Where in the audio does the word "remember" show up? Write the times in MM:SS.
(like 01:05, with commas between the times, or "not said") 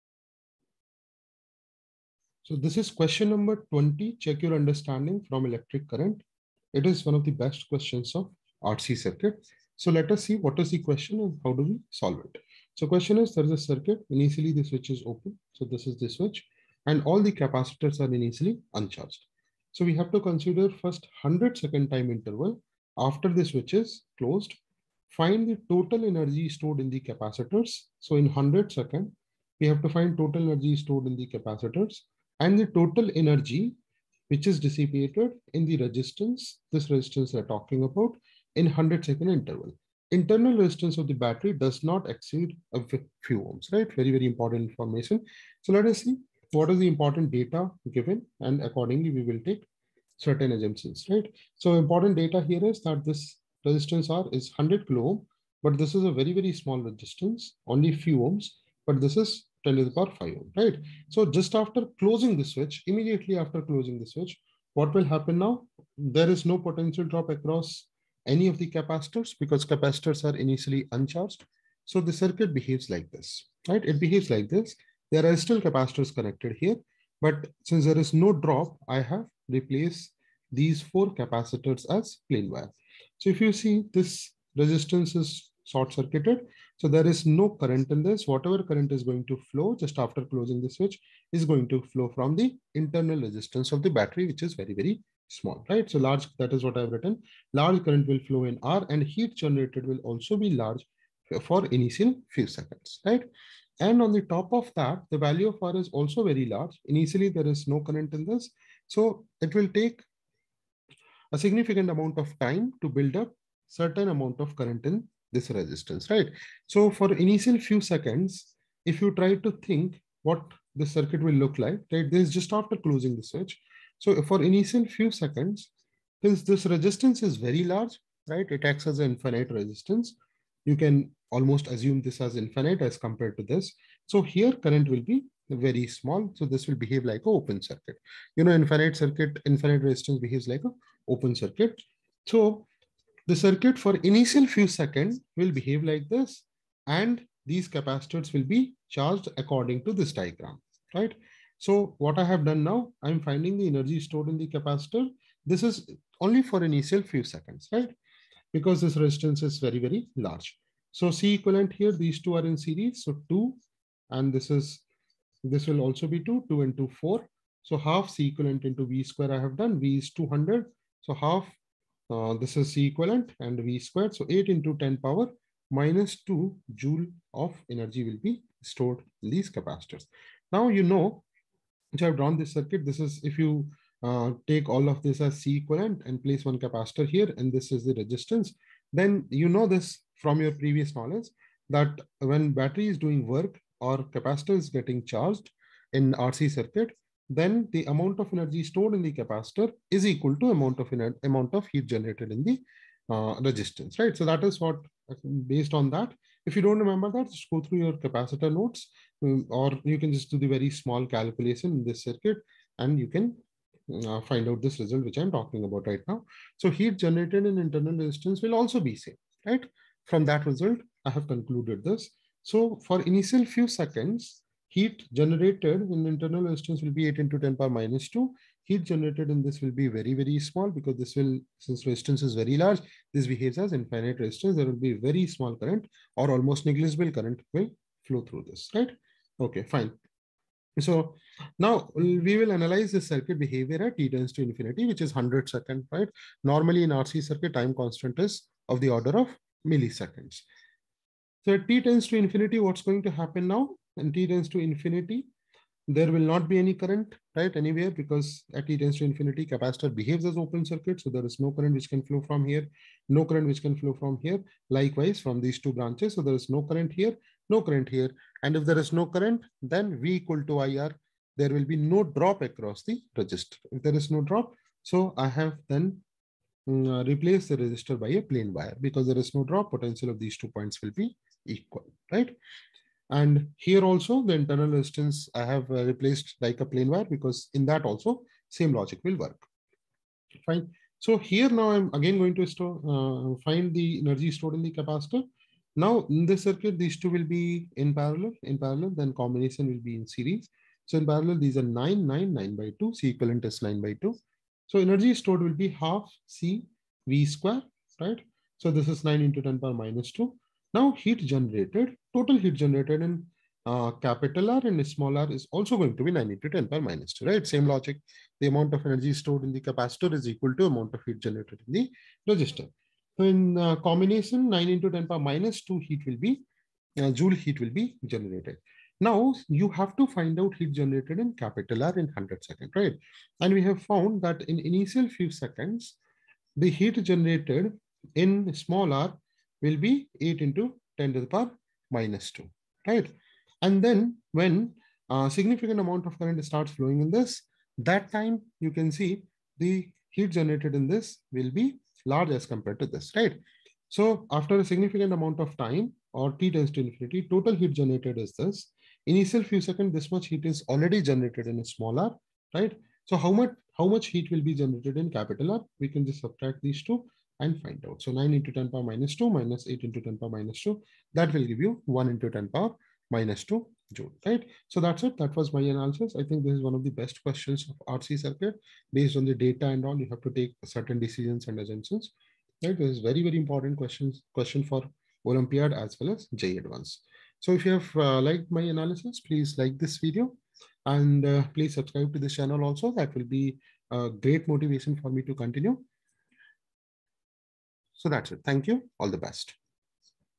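03:26.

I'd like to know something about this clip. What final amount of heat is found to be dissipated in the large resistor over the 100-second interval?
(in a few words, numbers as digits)
1 × 10^-2 J.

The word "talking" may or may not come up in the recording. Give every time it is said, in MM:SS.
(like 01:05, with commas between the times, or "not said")
00:37, 03:35.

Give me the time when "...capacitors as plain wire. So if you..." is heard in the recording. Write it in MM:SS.
01:21.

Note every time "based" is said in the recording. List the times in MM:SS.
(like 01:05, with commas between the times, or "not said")
03:25, 06:18.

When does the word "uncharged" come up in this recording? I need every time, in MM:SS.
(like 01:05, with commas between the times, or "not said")
00:18, 01:10.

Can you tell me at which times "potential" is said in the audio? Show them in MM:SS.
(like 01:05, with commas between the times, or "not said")
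01:06, 04:39.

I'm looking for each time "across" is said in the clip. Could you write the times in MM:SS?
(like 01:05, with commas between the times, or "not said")
01:07, 04:32.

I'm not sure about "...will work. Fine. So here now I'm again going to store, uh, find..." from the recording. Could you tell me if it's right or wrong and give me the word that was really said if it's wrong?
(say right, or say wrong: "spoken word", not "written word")
right.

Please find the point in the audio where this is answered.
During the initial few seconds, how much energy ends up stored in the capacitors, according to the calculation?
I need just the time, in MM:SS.
02:54.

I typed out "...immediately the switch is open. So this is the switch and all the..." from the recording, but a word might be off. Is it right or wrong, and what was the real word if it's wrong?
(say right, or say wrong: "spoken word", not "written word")
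wrong: "initially", not "immediately".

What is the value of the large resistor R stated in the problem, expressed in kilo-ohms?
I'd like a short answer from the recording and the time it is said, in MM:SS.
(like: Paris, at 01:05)
100 kilo ohm, at 00:54.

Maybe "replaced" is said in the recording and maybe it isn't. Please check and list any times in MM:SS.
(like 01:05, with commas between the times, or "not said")
01:19, 04:45.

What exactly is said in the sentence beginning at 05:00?
So in parallel, these are 9, 9, 9 by 2, C equivalent is 9 by 2.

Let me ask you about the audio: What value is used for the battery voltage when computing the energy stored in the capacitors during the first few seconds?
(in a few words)
200.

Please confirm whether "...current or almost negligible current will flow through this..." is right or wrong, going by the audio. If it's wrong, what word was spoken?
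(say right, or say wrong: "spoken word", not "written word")
right.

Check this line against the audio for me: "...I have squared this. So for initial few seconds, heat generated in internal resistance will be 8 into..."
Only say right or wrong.
wrong.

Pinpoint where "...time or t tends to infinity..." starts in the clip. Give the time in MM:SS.
05:55.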